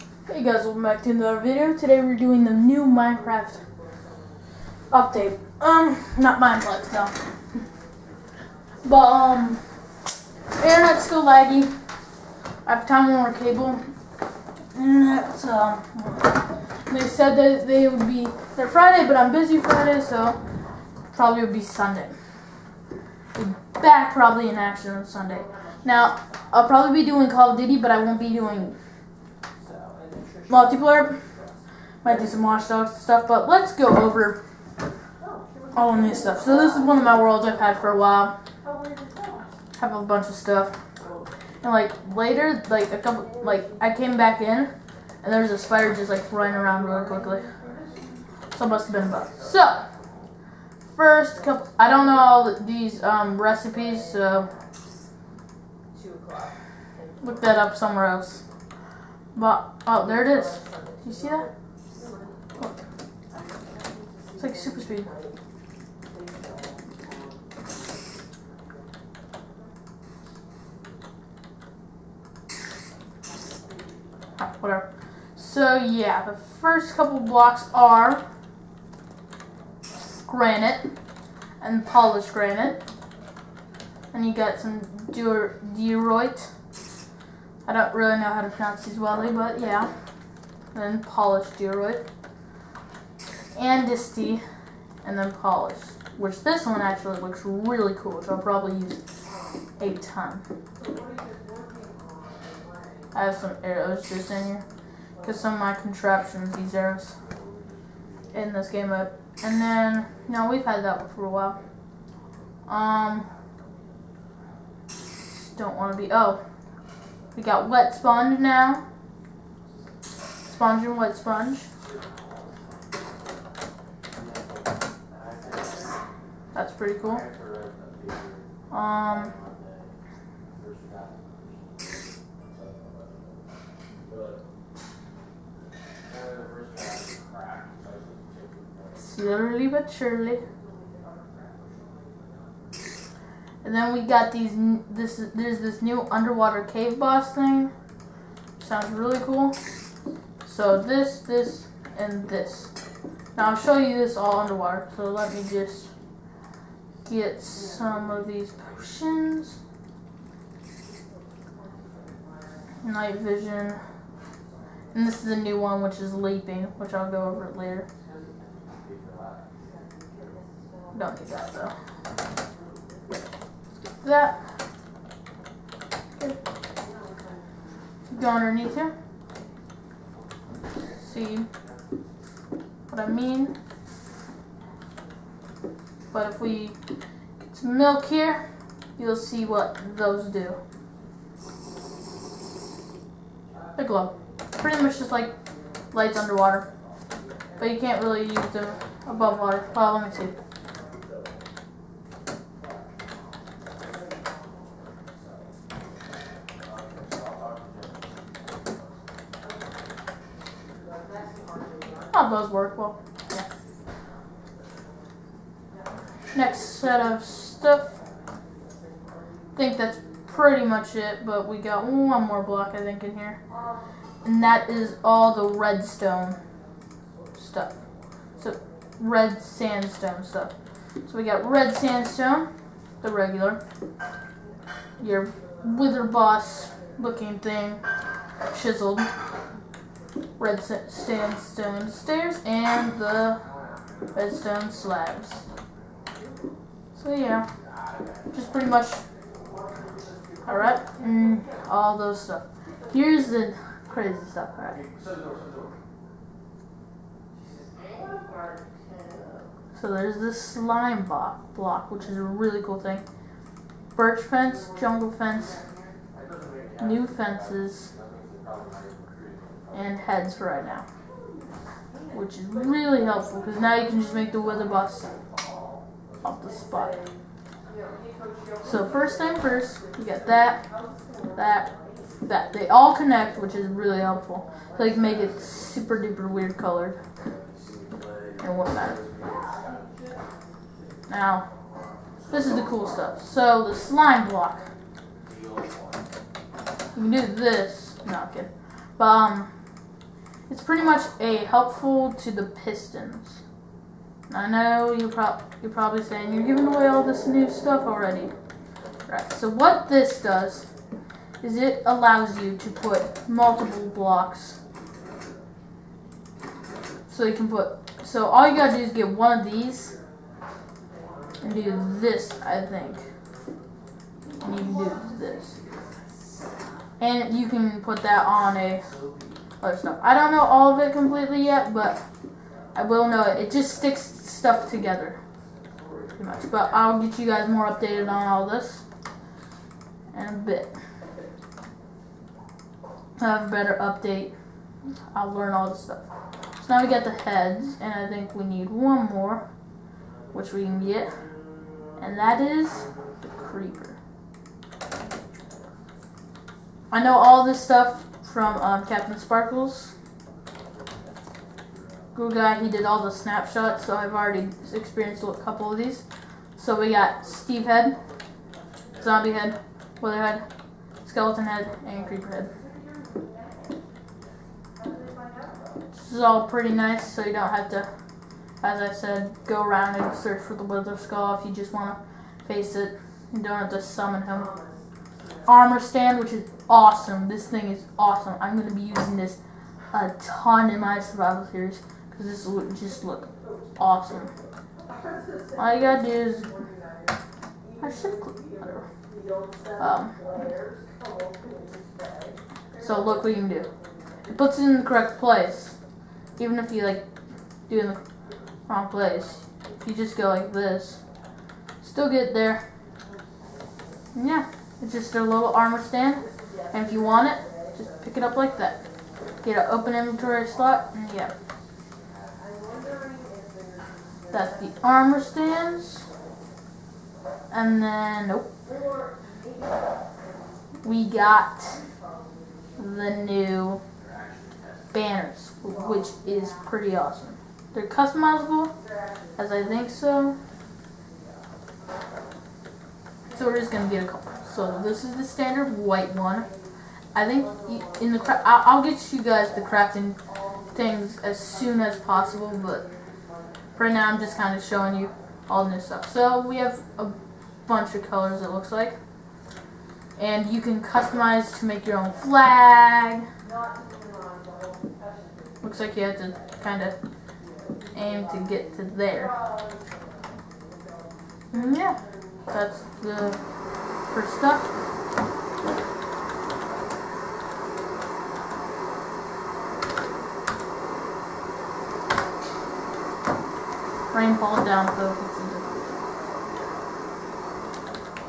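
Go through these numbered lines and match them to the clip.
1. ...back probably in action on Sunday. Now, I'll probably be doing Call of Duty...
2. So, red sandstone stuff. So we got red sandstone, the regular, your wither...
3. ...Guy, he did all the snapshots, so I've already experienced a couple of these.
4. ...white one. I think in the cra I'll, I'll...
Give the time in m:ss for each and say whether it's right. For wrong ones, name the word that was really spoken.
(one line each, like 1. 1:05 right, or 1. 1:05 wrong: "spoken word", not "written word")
1. 0:23 right
2. 3:48 right
3. 6:02 right
4. 7:25 right.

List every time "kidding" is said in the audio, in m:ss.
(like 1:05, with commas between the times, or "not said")
4:58.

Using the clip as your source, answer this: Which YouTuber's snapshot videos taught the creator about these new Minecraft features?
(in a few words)
Captain Sparklez.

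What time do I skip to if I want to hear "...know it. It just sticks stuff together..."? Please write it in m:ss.
5:33.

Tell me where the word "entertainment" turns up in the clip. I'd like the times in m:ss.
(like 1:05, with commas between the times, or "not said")
not said.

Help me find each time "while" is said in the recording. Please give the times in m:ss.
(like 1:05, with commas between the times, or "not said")
0:37, 1:51.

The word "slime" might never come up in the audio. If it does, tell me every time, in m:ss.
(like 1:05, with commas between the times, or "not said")
4:20, 4:53.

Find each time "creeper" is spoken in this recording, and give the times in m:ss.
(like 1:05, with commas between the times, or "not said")
5:53, 6:12.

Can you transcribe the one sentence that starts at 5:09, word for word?
Right, so what this does is it allows you to put multiple blocks.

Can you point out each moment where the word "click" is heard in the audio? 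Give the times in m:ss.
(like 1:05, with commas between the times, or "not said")
6:38.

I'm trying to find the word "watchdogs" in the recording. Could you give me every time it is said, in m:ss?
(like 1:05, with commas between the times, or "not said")
0:32.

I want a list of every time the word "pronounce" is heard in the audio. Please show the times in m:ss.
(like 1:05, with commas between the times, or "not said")
1:28.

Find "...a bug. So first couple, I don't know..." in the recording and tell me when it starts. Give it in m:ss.
0:49.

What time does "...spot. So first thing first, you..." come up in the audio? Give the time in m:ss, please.
4:36.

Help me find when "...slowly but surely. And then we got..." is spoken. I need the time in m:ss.
2:19.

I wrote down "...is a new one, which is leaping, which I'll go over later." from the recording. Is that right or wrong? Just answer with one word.
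right.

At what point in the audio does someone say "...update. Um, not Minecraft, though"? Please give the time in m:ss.
0:04.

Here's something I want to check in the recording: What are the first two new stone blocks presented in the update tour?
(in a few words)
Granite and polished granite.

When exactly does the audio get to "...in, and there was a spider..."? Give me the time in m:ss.
0:44.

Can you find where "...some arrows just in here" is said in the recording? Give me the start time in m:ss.
1:43.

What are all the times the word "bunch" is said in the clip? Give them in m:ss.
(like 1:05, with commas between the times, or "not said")
0:40, 7:37.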